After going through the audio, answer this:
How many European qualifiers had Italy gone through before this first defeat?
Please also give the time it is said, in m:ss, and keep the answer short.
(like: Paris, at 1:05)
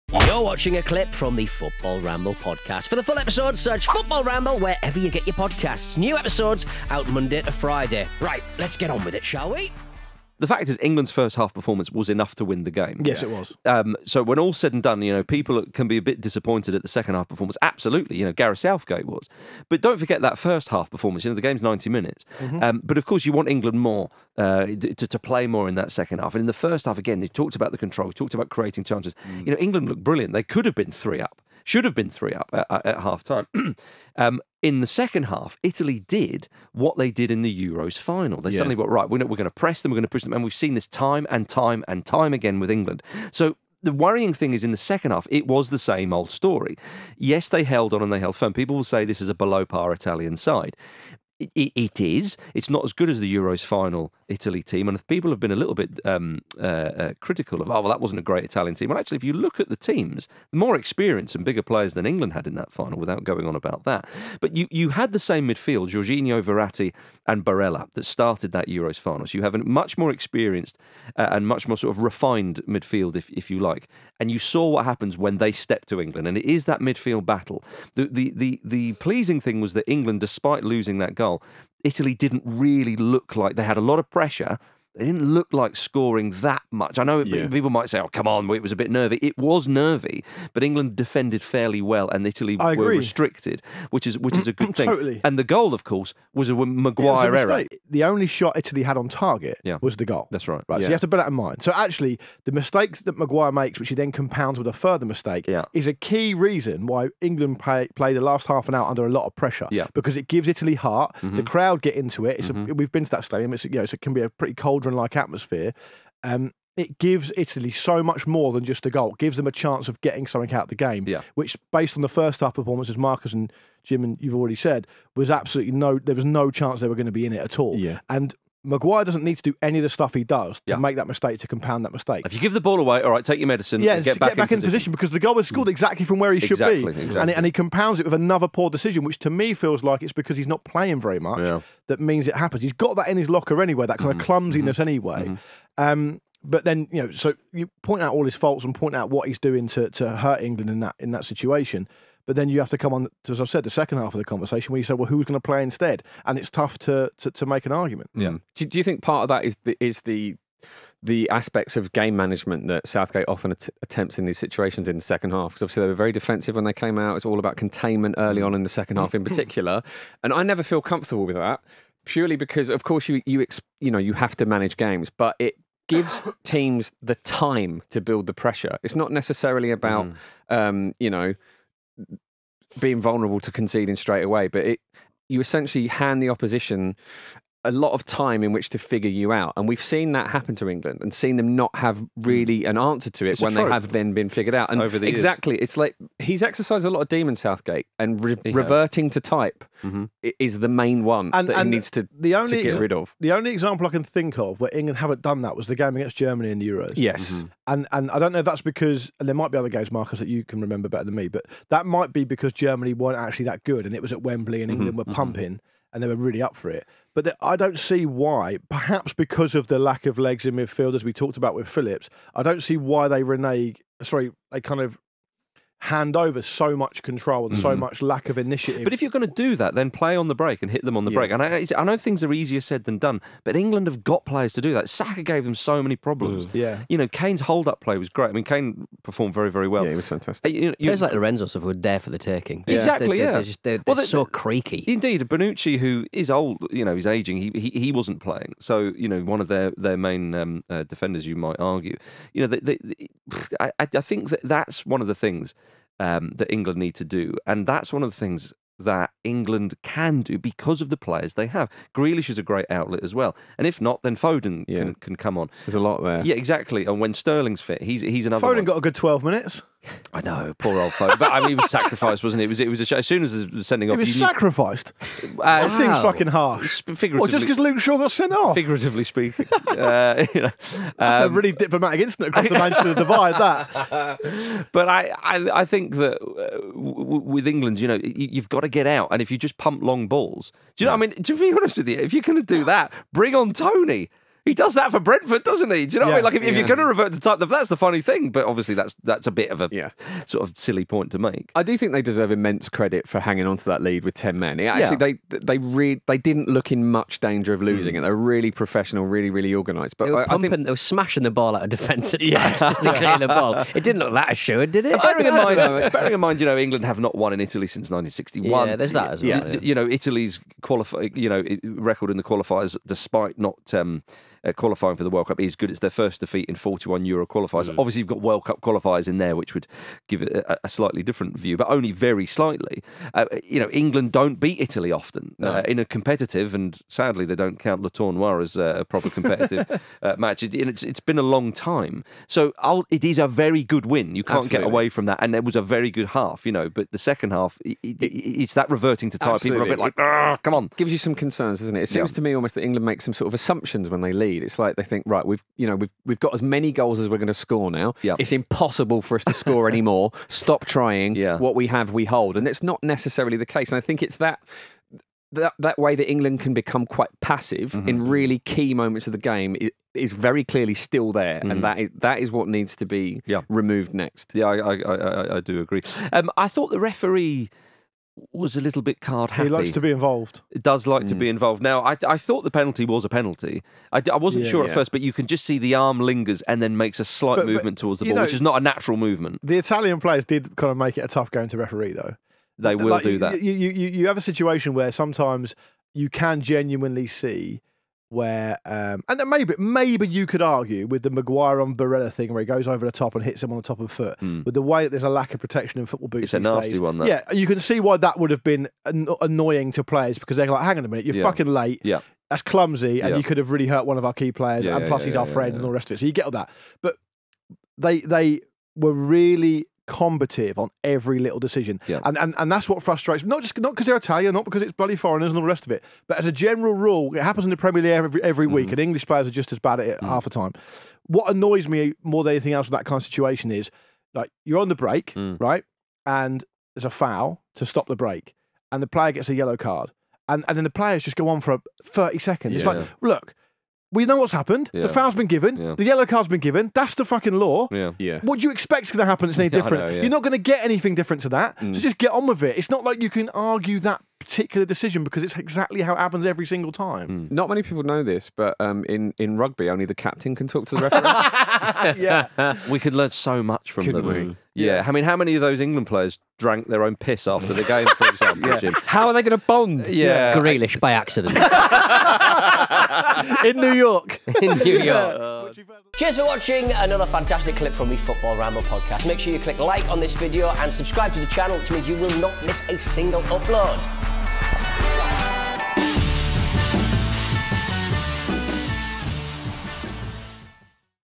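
41, at 5:26.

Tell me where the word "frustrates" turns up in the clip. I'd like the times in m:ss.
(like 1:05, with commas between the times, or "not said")
7:02.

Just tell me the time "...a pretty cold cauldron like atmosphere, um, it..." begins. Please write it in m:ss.
1:54.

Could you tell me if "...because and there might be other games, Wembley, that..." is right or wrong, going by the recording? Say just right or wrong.
wrong.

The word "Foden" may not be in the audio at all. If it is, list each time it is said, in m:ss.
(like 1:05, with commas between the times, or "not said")
4:24, 4:28.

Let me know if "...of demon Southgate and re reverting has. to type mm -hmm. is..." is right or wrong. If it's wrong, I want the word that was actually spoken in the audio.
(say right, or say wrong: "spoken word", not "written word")
right.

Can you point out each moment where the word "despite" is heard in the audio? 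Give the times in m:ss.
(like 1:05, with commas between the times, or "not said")
1:20, 5:22.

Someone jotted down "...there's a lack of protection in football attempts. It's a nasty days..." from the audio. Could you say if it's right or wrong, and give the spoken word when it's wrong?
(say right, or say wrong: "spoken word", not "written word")
wrong: "boots", not "attempts".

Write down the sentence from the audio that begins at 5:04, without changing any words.
actually, they they re- they didn't look in much danger of losing mm.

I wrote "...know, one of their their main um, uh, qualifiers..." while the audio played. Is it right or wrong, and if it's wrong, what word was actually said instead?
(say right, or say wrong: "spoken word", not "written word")
wrong: "defenders", not "qualifiers".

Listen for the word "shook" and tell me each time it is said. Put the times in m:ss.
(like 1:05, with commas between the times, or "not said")
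not said.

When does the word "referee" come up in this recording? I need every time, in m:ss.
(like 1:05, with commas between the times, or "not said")
6:16, 6:31, 7:40.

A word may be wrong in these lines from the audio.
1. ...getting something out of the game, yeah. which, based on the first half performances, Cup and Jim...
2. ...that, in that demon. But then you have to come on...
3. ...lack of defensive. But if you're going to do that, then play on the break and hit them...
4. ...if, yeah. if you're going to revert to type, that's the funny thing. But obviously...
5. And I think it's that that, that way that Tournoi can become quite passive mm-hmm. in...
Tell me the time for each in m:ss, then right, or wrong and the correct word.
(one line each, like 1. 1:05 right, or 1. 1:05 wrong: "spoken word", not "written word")
1. 2:00 wrong: "Marcus", not "Cup"
2. 2:30 wrong: "situation", not "demon"
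3. 3:48 wrong: "initiative", not "defensive"
4. 4:56 right
5. 6:03 wrong: "England", not "Tournoi".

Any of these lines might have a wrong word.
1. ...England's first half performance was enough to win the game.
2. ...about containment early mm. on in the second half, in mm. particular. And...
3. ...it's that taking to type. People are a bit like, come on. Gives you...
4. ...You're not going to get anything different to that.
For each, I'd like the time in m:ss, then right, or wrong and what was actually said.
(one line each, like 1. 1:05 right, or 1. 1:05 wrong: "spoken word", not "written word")
1. 0:10 right
2. 2:47 right
3. 5:48 wrong: "reverting", not "taking"
4. 7:30 right.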